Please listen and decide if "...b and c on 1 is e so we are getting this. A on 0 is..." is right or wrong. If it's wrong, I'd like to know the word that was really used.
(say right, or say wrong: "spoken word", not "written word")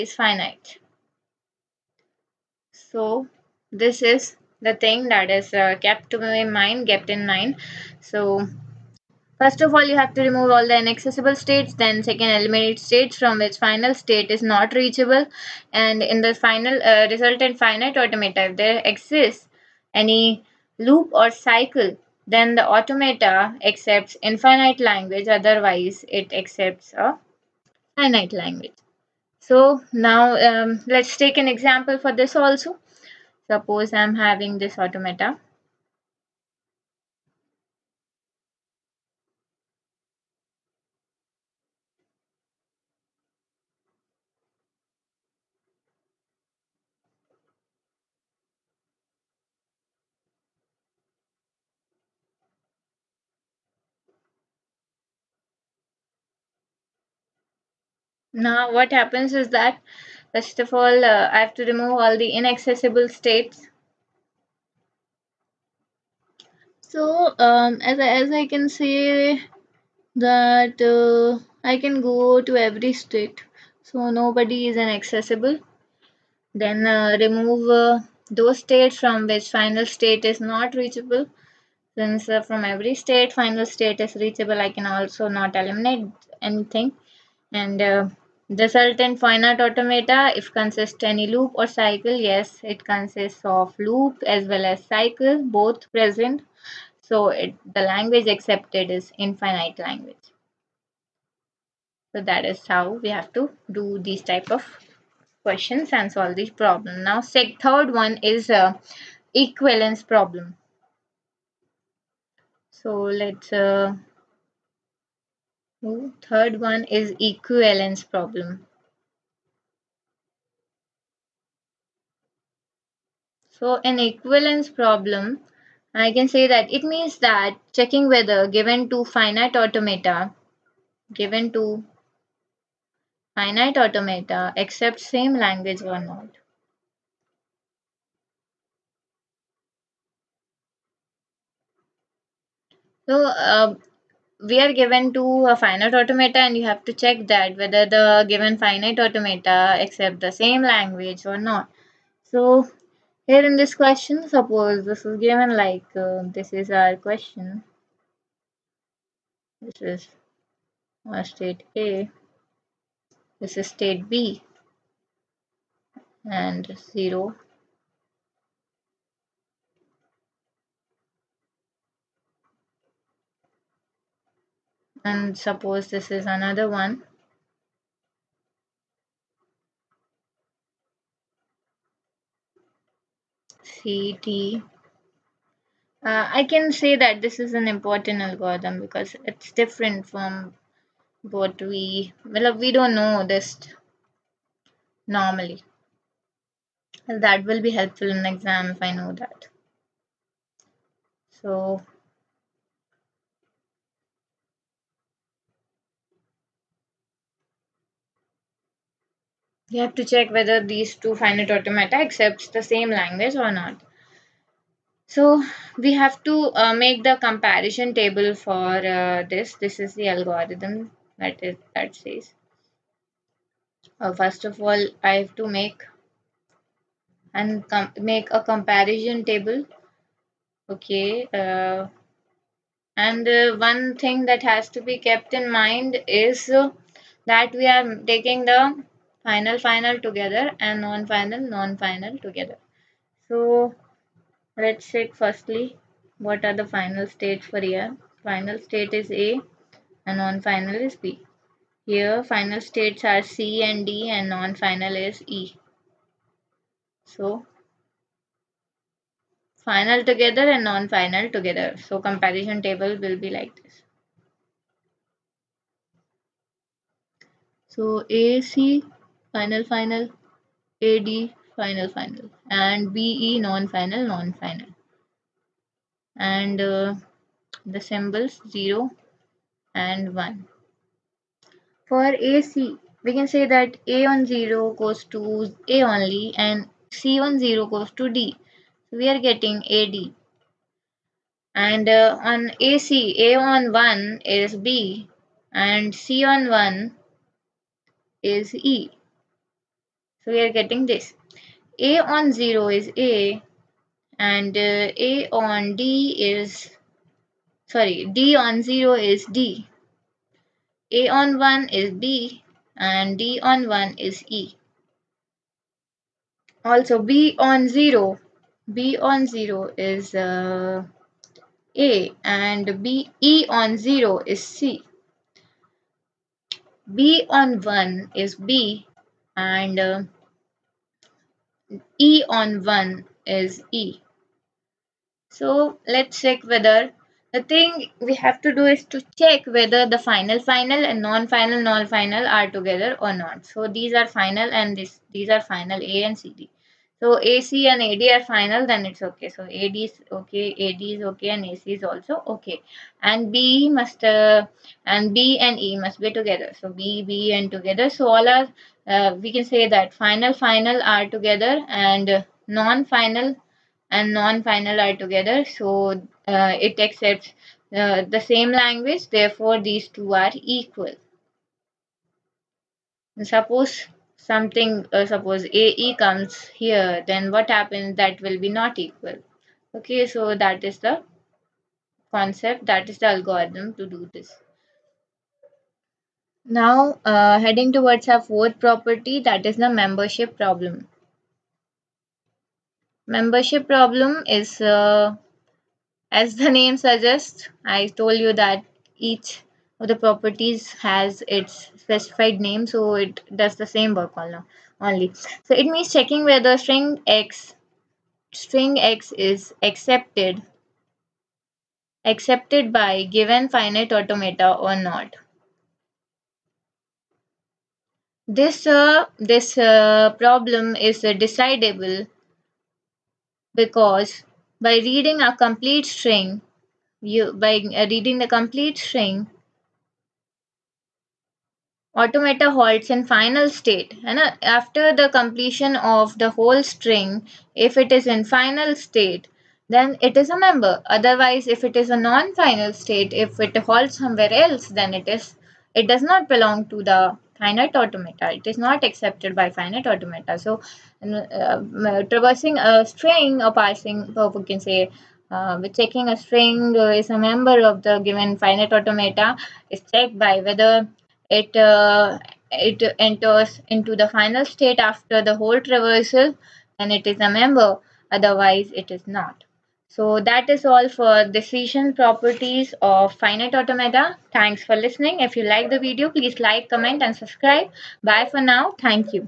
right.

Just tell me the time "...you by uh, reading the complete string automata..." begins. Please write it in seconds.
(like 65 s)
427 s.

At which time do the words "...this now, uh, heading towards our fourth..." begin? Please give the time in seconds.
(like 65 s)
384 s.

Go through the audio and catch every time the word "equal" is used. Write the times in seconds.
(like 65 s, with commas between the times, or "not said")
370 s, 378 s.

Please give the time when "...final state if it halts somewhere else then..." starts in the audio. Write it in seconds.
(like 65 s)
442 s.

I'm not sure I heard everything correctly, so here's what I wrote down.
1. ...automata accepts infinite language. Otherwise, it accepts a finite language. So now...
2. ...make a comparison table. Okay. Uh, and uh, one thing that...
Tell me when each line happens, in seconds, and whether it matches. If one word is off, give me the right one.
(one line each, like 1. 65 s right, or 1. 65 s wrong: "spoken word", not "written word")
1. 22 s right
2. 227 s right.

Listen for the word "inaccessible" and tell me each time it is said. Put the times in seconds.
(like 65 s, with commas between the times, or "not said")
10 s, 62 s, 74 s.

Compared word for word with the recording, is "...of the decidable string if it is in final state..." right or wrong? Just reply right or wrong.
wrong.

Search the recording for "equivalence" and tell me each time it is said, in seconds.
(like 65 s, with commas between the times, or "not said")
109 s, 117 s, 123 s.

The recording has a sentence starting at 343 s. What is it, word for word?
So these are final and this these are final A and CD.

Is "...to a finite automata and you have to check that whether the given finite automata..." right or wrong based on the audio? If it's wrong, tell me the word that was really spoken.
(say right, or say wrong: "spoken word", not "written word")
right.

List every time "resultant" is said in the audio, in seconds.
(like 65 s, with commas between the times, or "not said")
17 s, 88 s.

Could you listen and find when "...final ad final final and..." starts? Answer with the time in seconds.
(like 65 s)
269 s.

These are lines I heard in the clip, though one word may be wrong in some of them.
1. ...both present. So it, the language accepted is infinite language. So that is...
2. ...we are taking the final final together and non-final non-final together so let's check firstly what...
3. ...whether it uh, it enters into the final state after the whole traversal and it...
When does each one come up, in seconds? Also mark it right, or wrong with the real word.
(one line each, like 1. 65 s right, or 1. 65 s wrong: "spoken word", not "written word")
1. 95 s right
2. 237 s right
3. 460 s right.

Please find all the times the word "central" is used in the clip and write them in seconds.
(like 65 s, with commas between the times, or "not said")
not said.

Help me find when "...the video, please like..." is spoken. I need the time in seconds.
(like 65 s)
475 s.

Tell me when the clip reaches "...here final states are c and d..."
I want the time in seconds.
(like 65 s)
251 s.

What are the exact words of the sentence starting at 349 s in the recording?
So AD is okay, AD is okay and AC is also okay.